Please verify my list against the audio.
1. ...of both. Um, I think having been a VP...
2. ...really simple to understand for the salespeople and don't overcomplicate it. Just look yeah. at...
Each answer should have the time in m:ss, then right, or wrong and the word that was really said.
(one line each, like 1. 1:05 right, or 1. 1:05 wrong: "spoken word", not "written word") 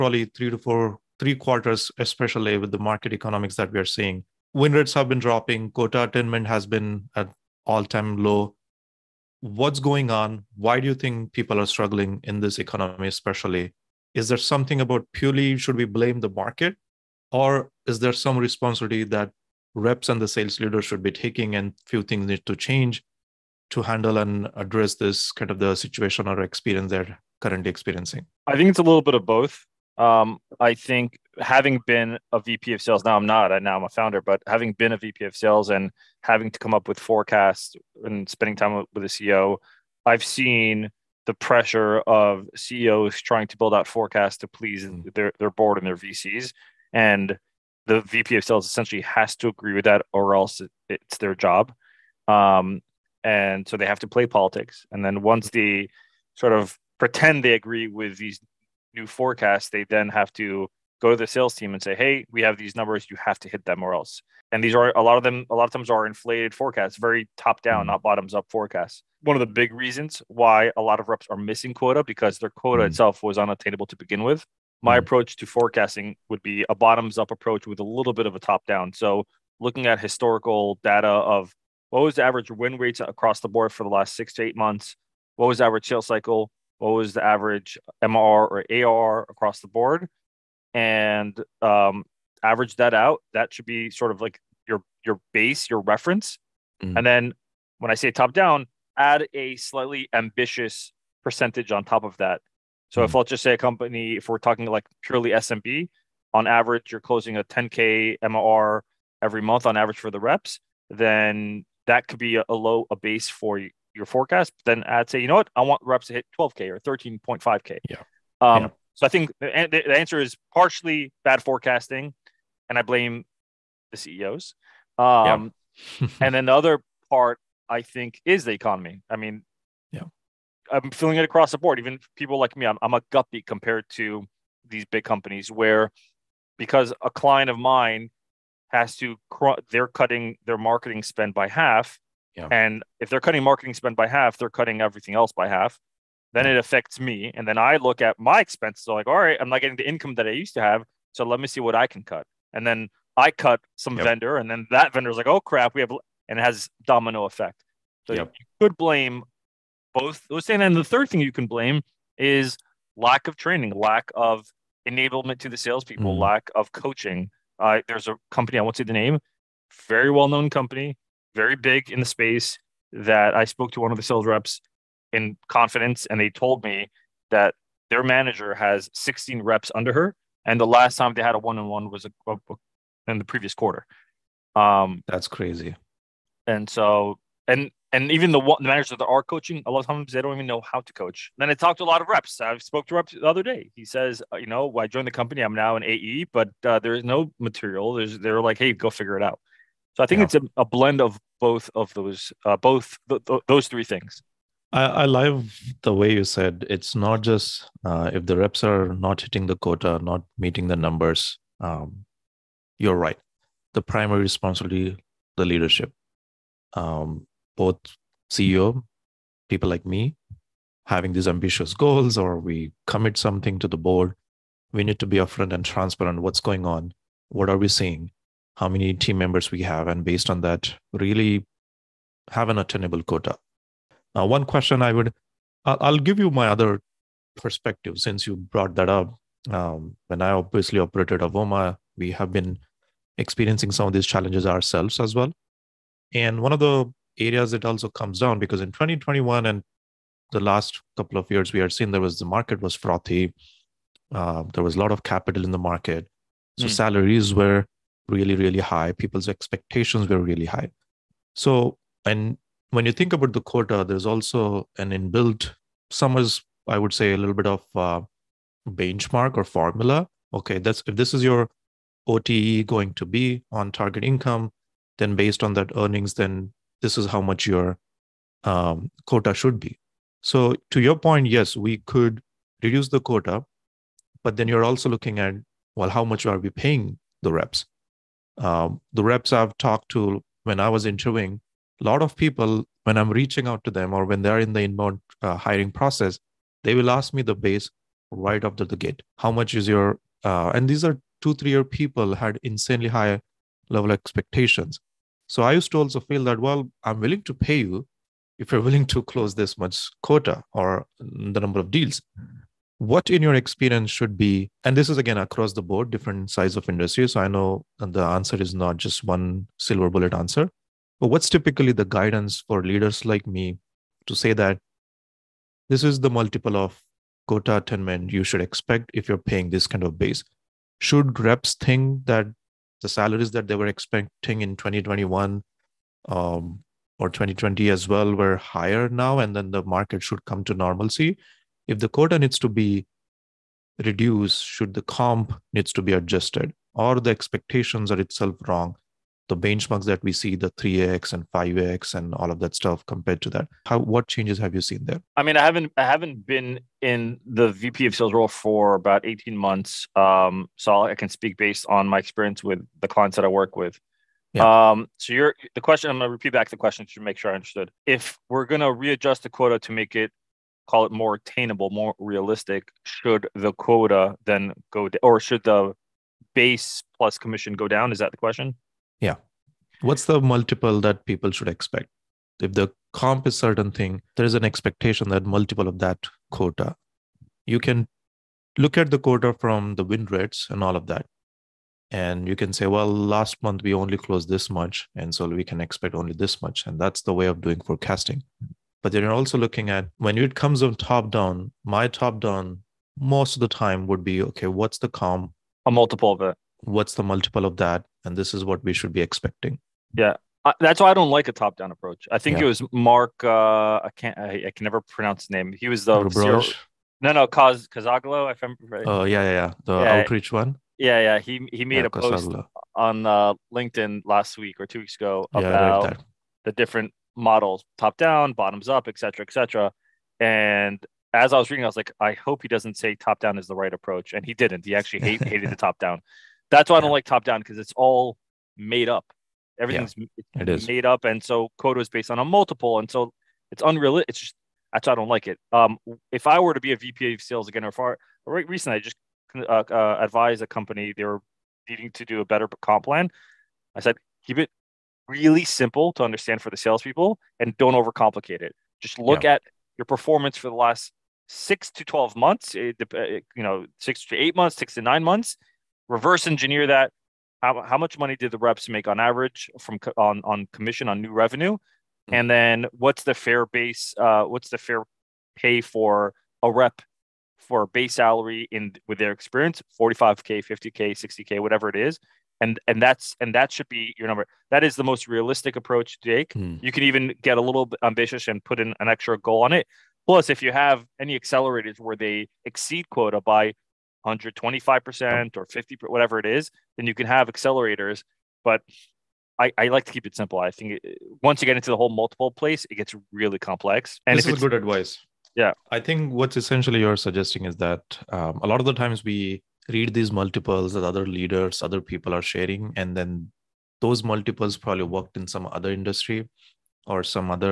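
1. 0:29 right
2. 7:35 right.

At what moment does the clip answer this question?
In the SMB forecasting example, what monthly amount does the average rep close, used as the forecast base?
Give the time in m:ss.
1:47.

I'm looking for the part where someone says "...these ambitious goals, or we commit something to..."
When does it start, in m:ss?
3:41.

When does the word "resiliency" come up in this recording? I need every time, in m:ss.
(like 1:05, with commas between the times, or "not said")
not said.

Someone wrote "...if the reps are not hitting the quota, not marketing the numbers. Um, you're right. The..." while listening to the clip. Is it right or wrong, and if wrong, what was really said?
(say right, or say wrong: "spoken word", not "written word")
wrong: "meeting", not "marketing".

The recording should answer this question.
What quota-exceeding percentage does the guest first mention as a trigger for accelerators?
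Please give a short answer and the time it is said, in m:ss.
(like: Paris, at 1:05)
125%, at 8:14.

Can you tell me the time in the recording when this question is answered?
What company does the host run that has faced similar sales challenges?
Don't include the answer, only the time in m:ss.
4:01.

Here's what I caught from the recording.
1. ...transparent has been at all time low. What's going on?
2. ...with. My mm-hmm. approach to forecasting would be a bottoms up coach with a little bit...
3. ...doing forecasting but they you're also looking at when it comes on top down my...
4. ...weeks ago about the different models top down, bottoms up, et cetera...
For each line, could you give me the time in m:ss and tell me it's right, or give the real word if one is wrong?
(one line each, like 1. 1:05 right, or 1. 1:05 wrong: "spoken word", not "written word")
1. 0:06 wrong: "attainment", not "transparent"
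2. 1:14 wrong: "approach", not "coach"
3. 6:37 right
4. 7:04 right.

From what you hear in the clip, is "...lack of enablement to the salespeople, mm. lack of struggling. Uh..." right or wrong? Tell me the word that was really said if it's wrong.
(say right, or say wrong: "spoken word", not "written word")
wrong: "coaching", not "struggling".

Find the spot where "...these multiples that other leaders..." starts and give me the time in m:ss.
8:29.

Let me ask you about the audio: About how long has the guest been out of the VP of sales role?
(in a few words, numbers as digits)
18 months.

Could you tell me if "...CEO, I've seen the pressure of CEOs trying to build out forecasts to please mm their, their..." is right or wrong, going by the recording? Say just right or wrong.
right.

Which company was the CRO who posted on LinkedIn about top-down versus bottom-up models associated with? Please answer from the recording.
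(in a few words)
Outreach.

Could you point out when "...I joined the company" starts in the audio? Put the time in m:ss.
3:14.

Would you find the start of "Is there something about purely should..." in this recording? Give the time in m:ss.
0:14.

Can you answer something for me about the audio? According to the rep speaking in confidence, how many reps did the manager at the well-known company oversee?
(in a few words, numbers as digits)
16.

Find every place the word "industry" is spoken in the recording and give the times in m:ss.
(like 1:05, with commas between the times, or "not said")
5:16, 8:35.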